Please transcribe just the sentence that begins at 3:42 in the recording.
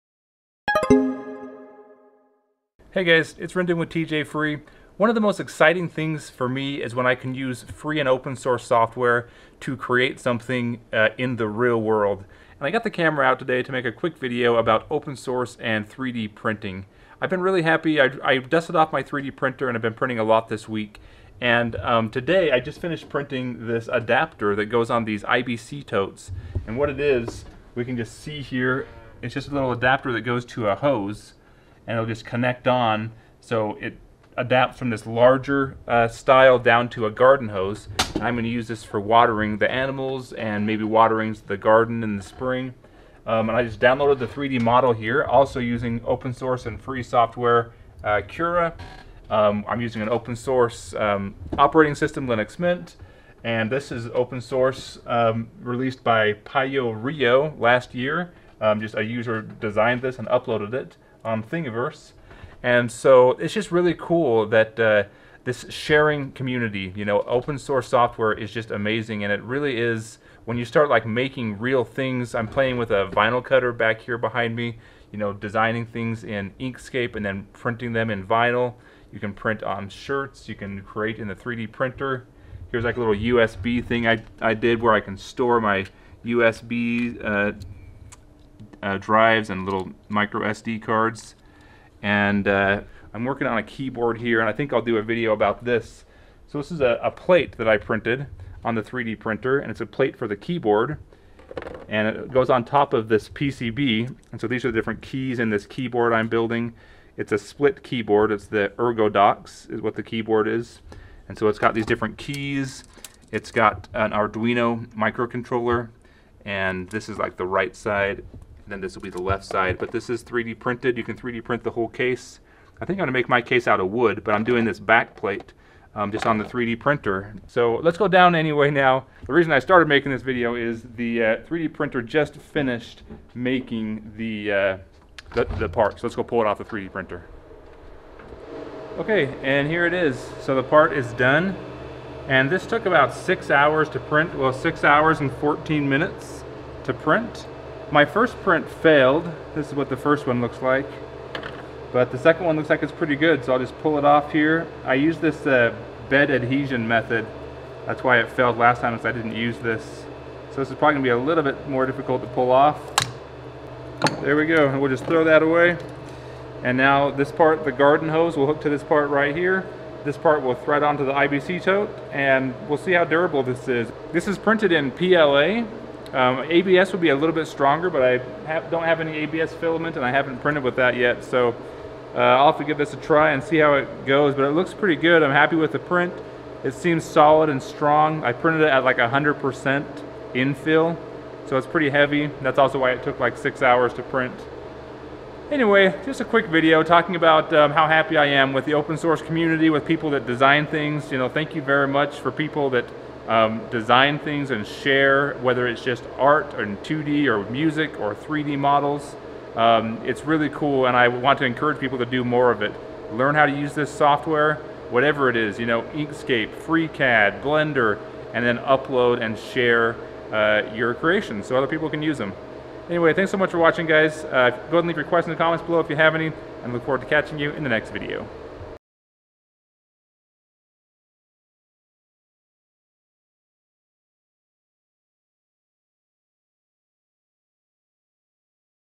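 Anyway, thanks so much for watching, guys.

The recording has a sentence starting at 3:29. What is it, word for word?
Um, it's really cool, and I want to encourage people to do more of it.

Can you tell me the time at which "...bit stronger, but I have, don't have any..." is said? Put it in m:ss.
2:57.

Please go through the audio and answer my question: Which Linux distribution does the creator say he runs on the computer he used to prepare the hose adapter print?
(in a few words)
Linux Mint.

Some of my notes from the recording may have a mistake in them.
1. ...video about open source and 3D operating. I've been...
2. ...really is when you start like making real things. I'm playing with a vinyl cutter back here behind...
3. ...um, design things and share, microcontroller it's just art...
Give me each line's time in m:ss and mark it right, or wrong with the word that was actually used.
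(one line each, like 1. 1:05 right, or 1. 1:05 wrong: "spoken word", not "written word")
1. 0:14 wrong: "printing", not "operating"
2. 1:09 right
3. 3:23 wrong: "whether", not "microcontroller".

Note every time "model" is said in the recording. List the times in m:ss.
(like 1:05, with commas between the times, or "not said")
0:44, 3:28.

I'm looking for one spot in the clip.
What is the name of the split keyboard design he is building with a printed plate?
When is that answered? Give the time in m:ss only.
1:48.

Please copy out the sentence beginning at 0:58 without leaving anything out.
Um, just a user designed this and uploaded it on um, Thingiverse.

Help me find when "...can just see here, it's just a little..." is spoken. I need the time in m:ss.
0:27.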